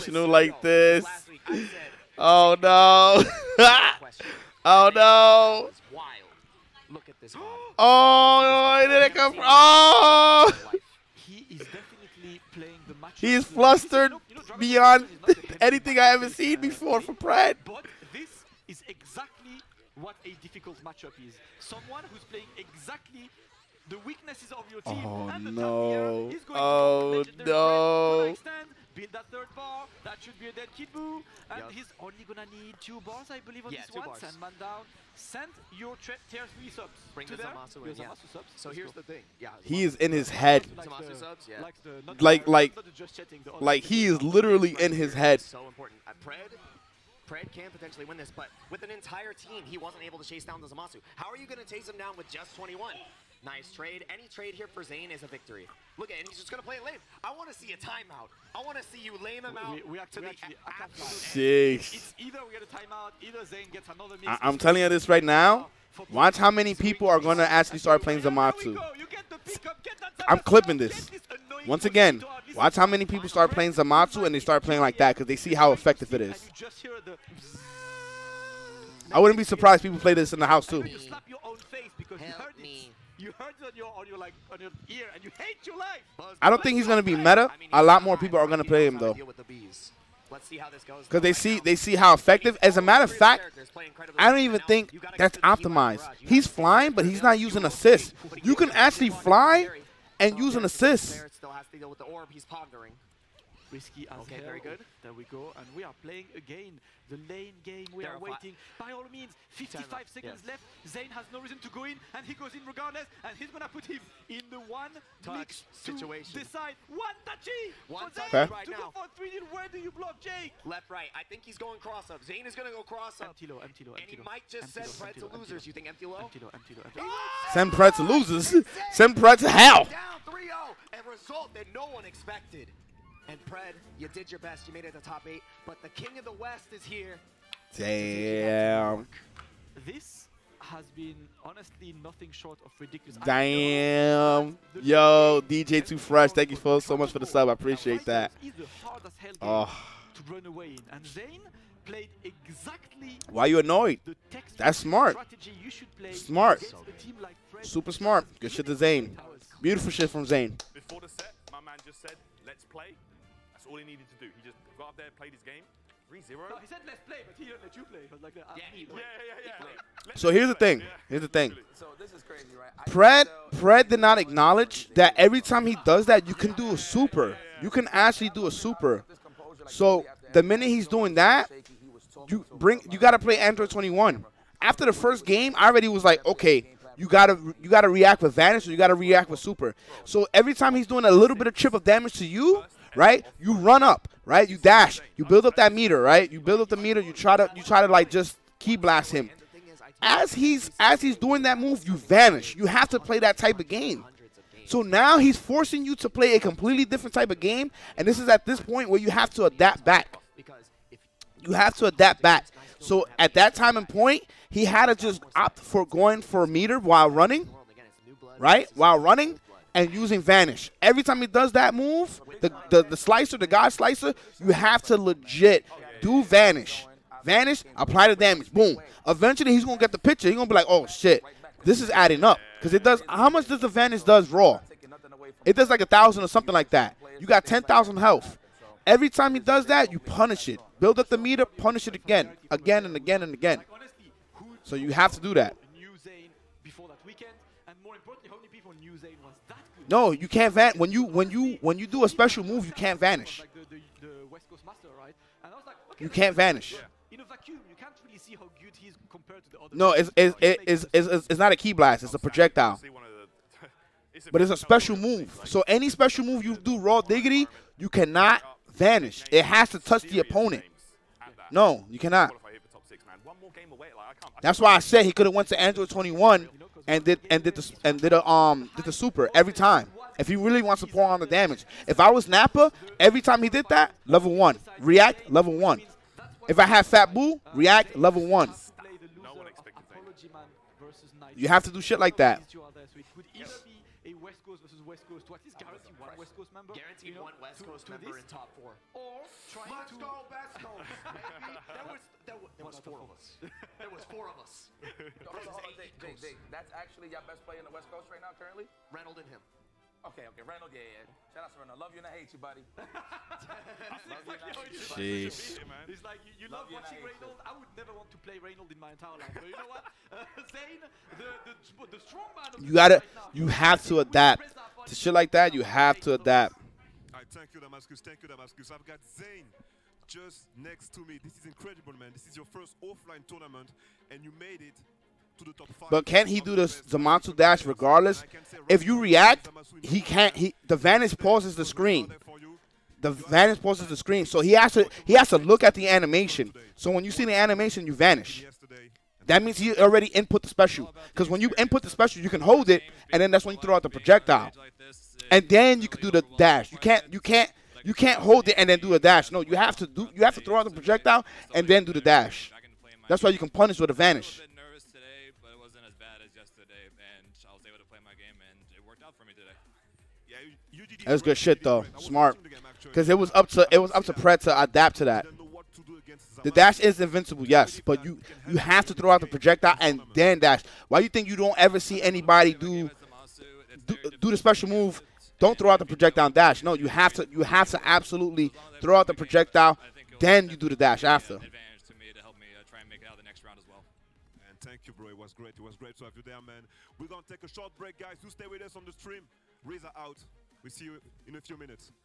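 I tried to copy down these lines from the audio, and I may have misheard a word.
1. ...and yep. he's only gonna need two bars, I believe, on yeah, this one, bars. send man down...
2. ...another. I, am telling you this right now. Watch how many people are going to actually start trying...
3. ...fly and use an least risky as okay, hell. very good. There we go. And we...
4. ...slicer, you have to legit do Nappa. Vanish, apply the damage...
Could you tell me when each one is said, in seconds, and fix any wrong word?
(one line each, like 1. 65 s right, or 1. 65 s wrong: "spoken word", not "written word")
1. 31 s right
2. 63 s wrong: "playing", not "trying"
3. 99 s wrong: "assist", not "least"
4. 223 s wrong: "Vanish", not "Nappa".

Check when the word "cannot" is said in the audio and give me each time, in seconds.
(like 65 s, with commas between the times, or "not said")
267 s, 271 s.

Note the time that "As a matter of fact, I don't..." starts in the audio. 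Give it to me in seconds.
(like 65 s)
92 s.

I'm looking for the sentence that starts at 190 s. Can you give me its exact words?
So every time he's doing a little bit of chip of damage to you, right?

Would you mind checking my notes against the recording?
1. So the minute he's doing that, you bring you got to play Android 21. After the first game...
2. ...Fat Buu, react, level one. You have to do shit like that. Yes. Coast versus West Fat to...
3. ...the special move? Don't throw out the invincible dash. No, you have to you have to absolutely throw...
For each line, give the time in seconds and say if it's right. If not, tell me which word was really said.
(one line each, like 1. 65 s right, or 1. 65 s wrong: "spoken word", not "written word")
1. 179 s right
2. 286 s wrong: "Coast", not "Fat"
3. 384 s wrong: "projectile", not "invincible".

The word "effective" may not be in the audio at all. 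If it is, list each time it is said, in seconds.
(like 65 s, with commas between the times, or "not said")
75 s, 92 s.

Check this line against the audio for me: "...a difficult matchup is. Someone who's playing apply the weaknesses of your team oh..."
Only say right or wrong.
wrong.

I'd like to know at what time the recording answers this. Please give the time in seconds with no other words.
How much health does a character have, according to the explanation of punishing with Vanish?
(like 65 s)
237 s.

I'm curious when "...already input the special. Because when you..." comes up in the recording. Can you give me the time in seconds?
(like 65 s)
349 s.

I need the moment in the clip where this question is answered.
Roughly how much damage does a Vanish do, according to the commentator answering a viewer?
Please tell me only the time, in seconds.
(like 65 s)
235 s.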